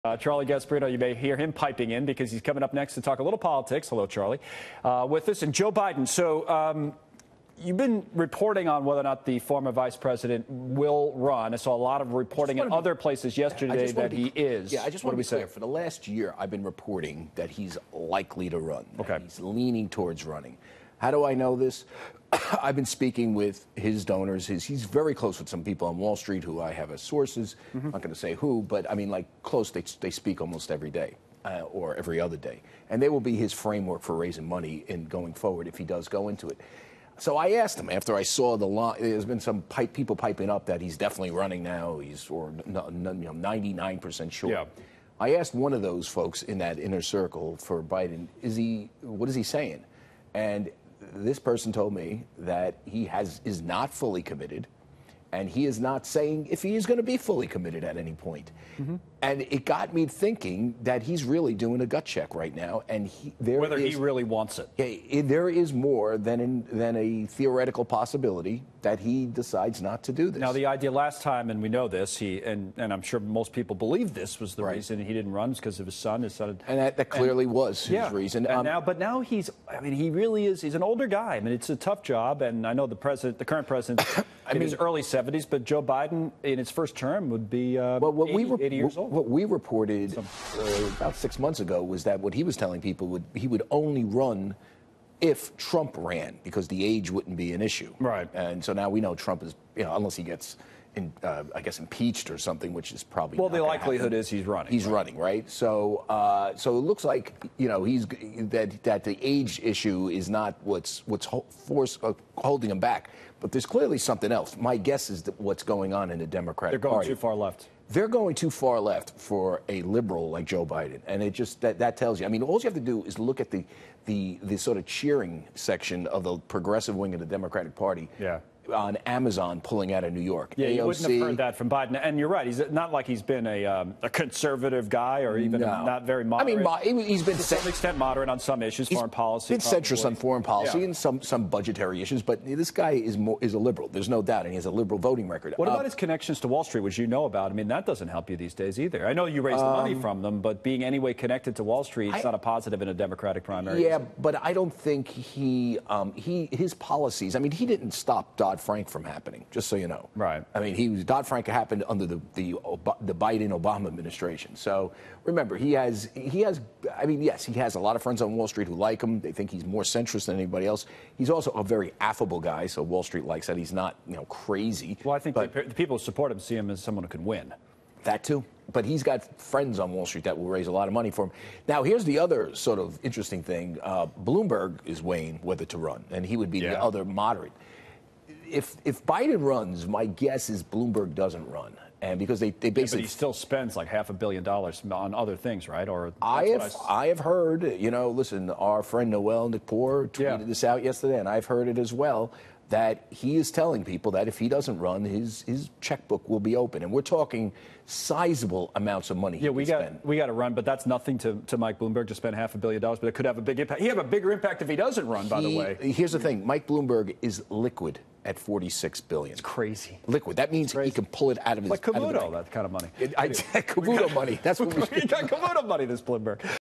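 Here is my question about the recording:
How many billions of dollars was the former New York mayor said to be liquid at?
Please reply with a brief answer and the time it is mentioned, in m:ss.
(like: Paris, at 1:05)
46 billion, at 3:38.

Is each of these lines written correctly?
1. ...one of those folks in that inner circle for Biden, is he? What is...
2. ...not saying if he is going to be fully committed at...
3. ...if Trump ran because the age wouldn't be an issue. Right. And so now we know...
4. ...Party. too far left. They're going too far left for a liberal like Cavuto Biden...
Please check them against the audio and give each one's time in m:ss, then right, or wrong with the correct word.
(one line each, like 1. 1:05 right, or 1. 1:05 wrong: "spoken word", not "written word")
1. 0:45 right
2. 0:55 right
3. 1:35 right
4. 1:57 wrong: "Joe", not "Cavuto".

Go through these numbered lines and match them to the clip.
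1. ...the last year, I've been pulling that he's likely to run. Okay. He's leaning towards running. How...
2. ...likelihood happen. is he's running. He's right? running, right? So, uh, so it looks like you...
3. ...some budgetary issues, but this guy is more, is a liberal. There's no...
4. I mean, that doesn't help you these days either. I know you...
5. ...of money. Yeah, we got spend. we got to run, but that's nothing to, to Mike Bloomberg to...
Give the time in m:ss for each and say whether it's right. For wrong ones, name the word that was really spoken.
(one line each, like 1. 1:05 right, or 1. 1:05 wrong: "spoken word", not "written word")
1. 0:15 wrong: "reporting", not "pulling"
2. 1:43 right
3. 2:21 right
4. 2:27 right
5. 3:29 right.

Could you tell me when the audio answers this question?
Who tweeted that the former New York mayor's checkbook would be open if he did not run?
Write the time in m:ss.
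3:19.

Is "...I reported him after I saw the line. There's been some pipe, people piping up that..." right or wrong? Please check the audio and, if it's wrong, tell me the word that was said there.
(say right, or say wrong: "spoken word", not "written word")
wrong: "asked", not "reported".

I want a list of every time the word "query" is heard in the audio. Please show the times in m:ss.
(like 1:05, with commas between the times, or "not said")
not said.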